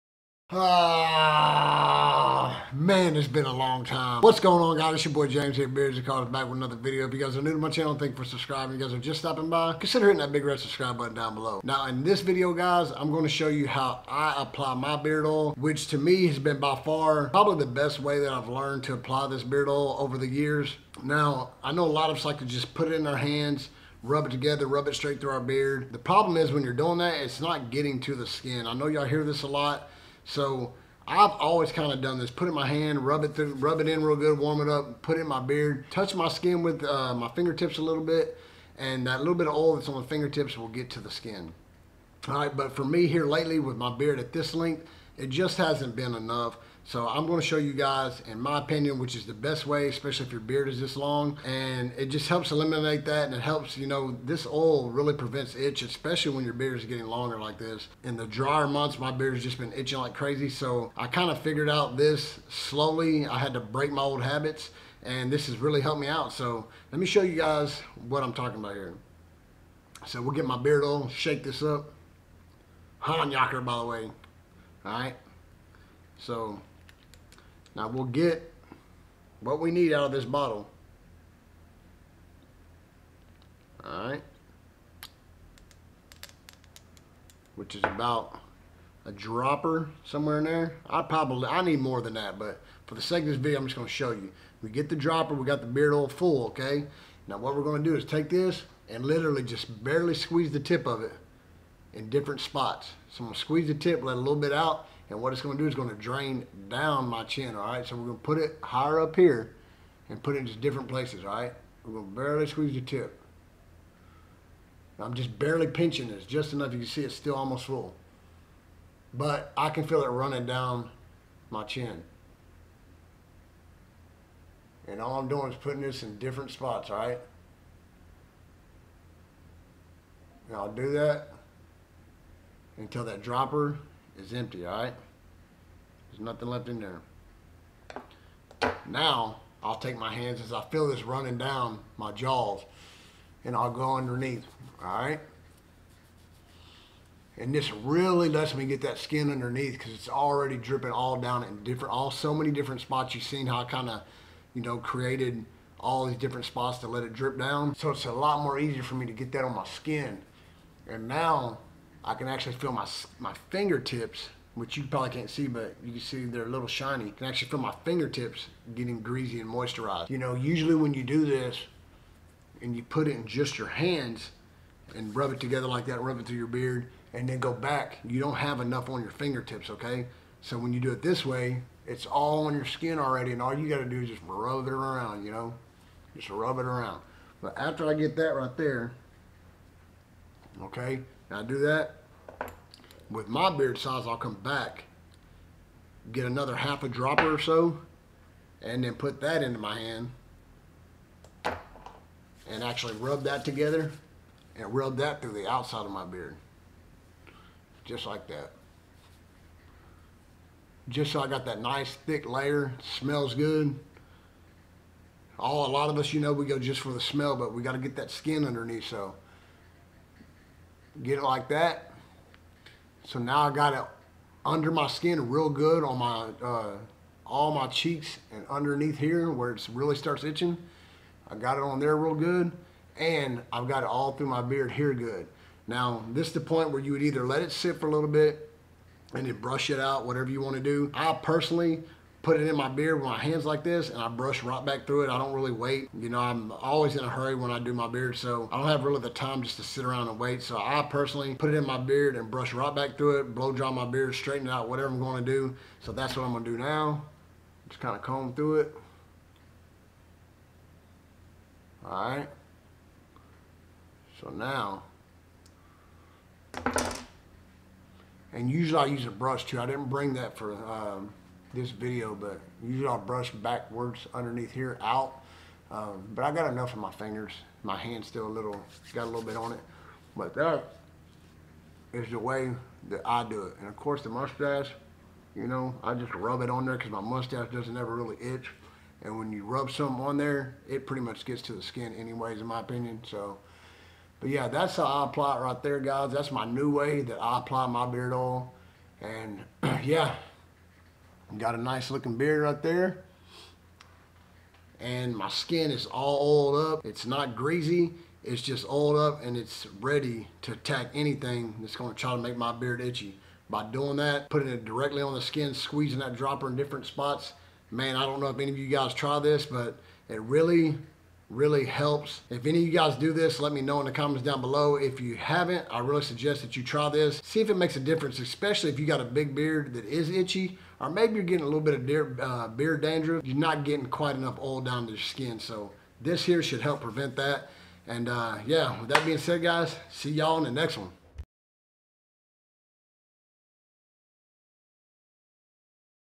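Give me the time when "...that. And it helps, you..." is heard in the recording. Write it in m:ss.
0:53.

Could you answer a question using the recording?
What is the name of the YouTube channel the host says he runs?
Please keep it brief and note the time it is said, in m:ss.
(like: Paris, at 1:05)
Beards and Cars, at 0:05.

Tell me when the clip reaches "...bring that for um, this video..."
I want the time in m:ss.
4:29.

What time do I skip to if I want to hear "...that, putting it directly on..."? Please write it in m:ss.
5:13.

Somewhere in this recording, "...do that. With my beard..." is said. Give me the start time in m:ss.
3:11.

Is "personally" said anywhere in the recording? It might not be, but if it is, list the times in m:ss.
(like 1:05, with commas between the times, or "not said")
4:01, 4:10.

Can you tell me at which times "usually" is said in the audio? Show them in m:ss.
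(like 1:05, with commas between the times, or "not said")
2:50, 4:28, 4:32.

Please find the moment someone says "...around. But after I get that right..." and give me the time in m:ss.
3:06.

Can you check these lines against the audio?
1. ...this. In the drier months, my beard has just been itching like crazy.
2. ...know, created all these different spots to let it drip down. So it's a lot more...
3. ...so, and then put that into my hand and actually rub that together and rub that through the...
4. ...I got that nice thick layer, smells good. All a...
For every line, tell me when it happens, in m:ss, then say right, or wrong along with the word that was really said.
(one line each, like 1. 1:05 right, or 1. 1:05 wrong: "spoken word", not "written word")
1. 0:57 right
2. 2:34 right
3. 3:17 right
4. 3:31 right.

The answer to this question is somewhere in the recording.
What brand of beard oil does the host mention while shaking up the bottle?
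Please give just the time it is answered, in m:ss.
1:12.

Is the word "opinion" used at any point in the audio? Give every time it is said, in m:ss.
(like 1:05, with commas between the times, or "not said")
0:48, 4:52.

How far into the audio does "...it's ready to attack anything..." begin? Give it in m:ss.
5:09.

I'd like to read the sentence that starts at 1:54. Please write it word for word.
I'm just barely pinching this, just enough you can see it's still almost full.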